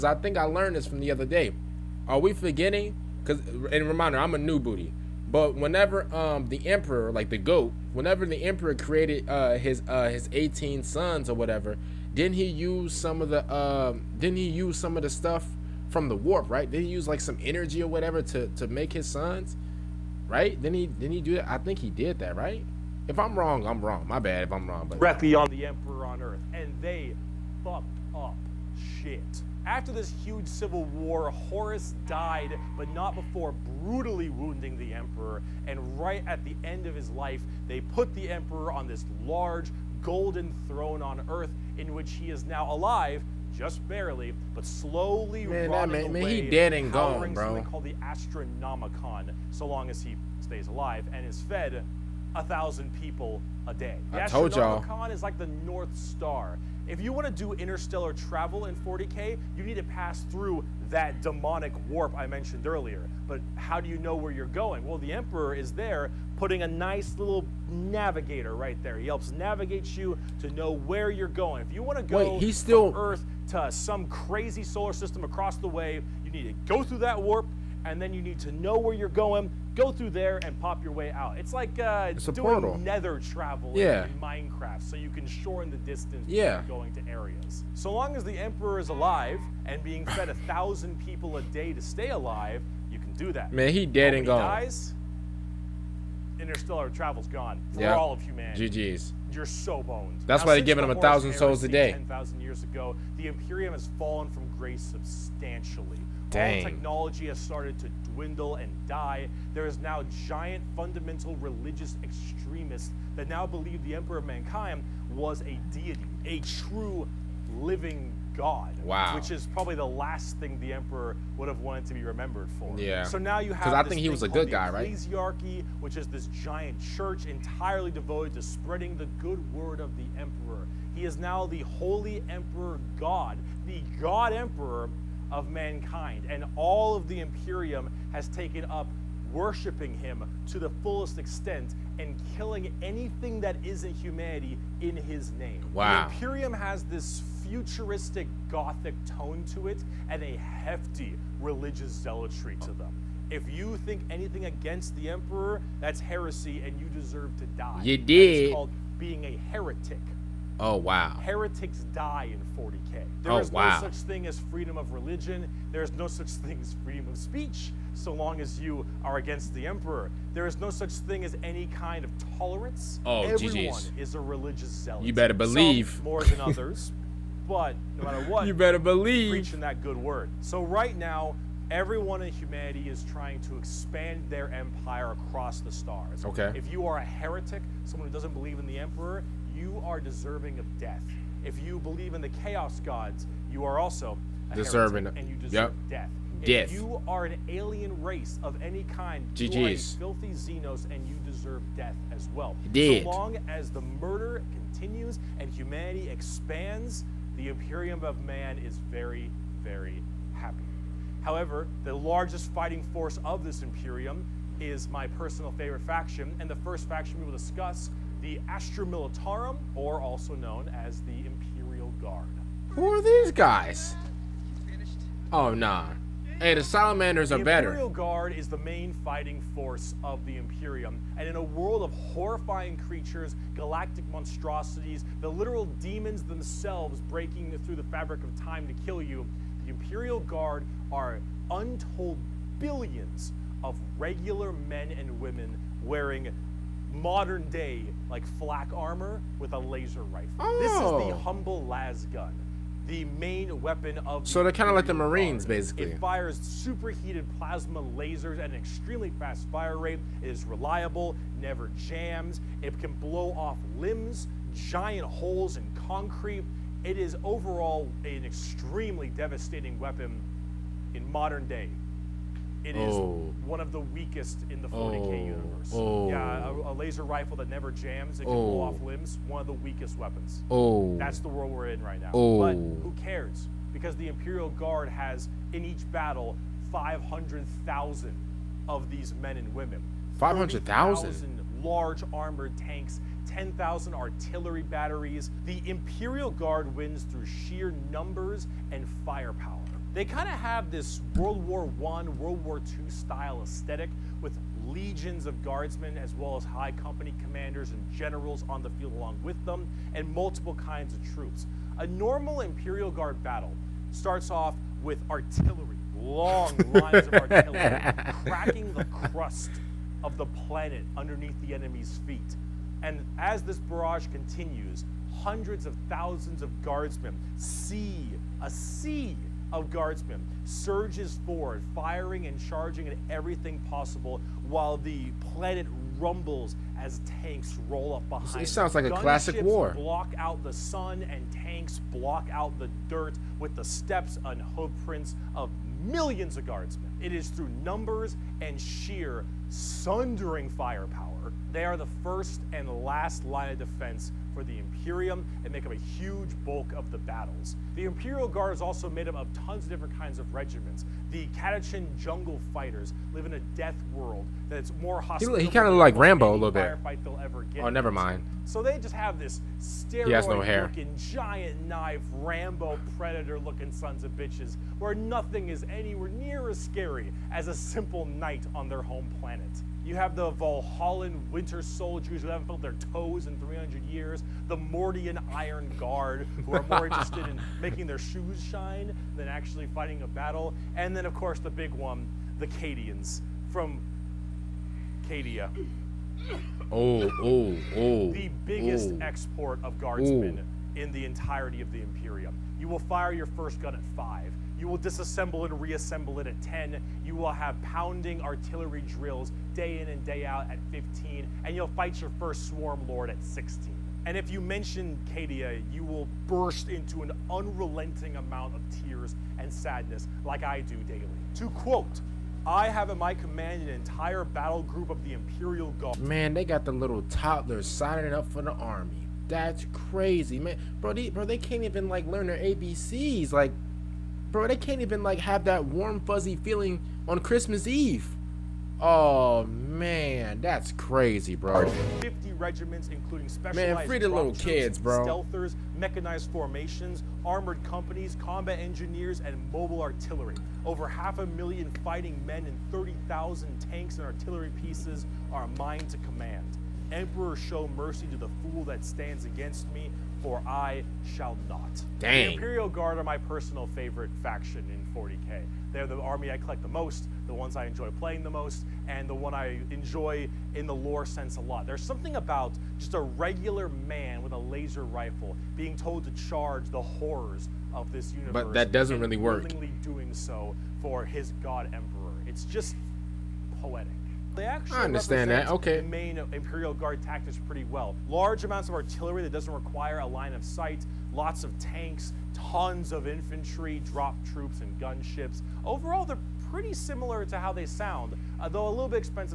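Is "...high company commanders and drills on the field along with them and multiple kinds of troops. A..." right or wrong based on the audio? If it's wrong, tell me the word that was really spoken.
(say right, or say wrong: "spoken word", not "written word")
wrong: "generals", not "drills".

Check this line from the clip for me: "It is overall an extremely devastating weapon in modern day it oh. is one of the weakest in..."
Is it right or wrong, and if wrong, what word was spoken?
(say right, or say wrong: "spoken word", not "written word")
right.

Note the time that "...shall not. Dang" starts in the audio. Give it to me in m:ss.
7:41.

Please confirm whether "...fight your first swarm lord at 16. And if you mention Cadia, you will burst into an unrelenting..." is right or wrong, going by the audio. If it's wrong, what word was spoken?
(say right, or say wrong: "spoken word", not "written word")
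right.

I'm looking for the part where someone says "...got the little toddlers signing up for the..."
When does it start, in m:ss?
7:06.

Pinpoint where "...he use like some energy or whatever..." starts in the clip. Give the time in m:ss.
0:16.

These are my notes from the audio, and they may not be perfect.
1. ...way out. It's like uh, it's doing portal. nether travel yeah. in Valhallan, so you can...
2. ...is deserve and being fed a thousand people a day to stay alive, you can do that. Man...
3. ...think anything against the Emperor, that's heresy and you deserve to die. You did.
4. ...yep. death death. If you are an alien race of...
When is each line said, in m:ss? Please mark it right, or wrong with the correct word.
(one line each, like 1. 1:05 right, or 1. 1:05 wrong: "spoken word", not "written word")
1. 1:20 wrong: "Minecraft", not "Valhallan"
2. 1:28 wrong: "alive", not "deserve"
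3. 2:33 right
4. 3:15 right.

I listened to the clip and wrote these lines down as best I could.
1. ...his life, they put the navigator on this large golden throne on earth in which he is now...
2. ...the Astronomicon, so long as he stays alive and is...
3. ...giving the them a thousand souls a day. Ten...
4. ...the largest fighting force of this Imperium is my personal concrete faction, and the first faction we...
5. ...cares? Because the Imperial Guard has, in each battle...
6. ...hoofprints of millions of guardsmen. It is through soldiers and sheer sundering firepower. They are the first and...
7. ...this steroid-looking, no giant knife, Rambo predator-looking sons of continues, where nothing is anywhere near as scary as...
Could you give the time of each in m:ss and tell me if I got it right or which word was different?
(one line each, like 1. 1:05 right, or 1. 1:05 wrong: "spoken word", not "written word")
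1. 0:36 wrong: "emperor", not "navigator"
2. 0:47 right
3. 1:40 right
4. 3:31 wrong: "favorite", not "concrete"
5. 4:42 right
6. 5:44 wrong: "numbers", not "soldiers"
7. 6:09 wrong: "bitches", not "continues".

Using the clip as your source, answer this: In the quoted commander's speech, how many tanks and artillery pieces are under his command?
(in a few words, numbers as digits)
30,000.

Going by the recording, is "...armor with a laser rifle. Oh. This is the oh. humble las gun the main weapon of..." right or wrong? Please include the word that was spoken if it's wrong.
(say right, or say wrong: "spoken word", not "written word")
right.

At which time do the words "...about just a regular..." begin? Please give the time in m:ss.
7:52.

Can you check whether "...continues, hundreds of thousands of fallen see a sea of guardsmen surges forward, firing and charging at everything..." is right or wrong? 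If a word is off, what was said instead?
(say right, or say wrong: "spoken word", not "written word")
wrong: "guardsmen", not "fallen".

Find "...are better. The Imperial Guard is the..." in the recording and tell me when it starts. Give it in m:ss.
3:47.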